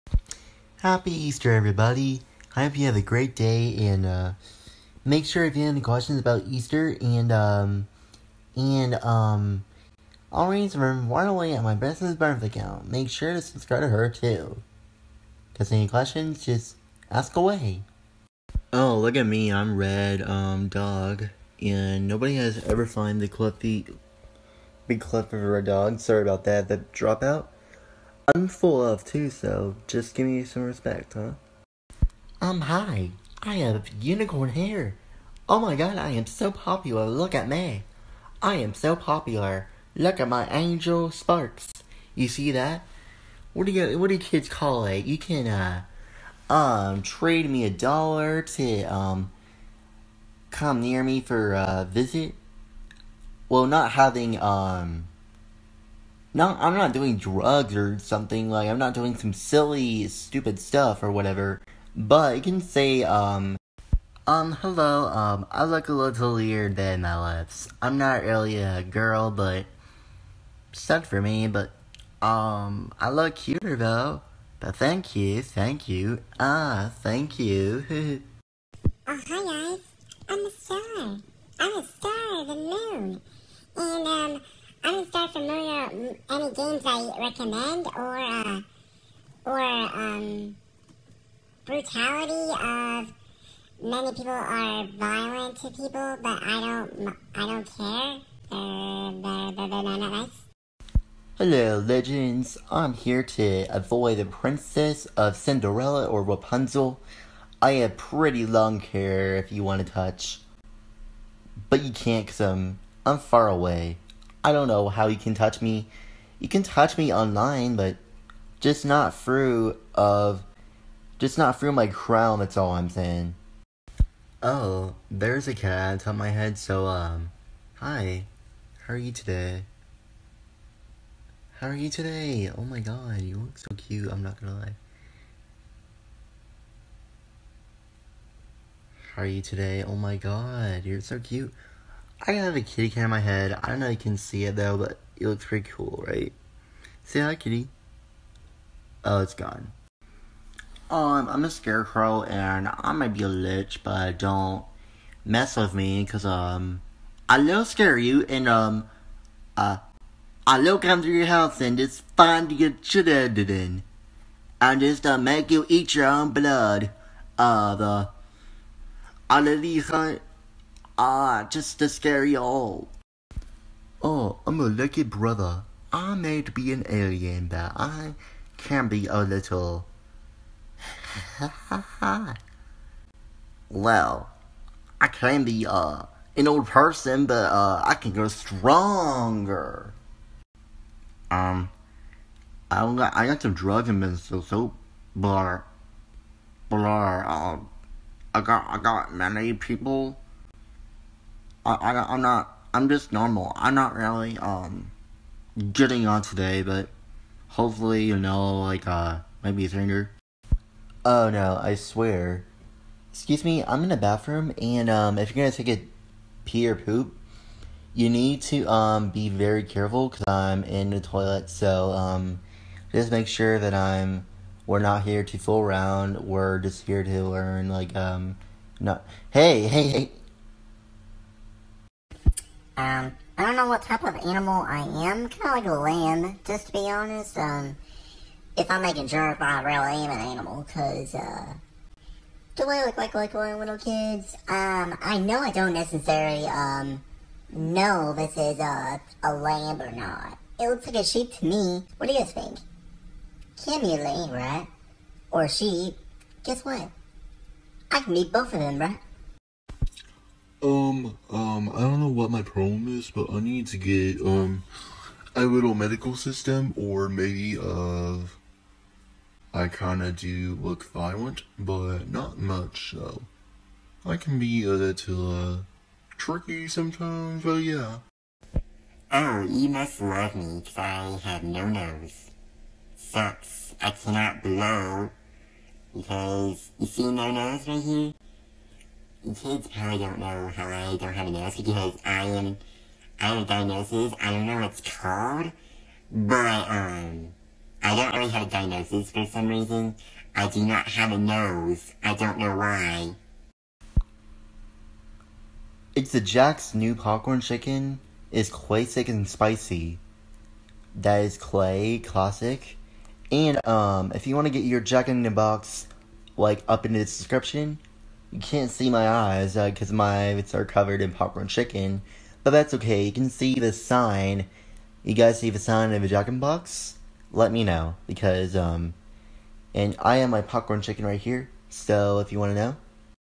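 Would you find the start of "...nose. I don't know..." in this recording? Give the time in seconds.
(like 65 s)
301 s.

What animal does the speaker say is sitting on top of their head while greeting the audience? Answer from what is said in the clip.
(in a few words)
a cat.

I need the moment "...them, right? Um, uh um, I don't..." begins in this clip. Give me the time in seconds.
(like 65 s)
258 s.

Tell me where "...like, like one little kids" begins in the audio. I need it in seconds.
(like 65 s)
242 s.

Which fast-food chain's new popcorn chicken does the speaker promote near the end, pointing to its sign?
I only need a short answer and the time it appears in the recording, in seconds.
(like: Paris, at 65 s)
Jack in the Box, at 314 s.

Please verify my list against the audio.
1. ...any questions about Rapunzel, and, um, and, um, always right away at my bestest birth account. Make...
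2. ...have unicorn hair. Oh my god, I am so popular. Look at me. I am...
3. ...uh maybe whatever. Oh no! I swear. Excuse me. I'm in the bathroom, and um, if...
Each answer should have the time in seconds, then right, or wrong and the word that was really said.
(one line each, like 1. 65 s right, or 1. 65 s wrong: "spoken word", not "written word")
1. 5 s wrong: "Easter", not "Rapunzel"
2. 33 s right
3. 208 s wrong: "stranger", not "whatever".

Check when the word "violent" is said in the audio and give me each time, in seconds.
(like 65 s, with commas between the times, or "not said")
94 s, 270 s.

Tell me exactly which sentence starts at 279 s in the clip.
Oh, you must love me, because I have no nose.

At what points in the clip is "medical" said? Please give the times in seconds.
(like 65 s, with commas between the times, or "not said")
265 s.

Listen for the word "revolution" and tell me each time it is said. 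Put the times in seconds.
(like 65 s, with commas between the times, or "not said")
not said.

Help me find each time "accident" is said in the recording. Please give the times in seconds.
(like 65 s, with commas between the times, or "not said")
not said.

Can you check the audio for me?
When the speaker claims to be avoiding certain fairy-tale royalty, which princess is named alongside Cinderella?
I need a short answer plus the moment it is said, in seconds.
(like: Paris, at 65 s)
Rapunzel, at 106 s.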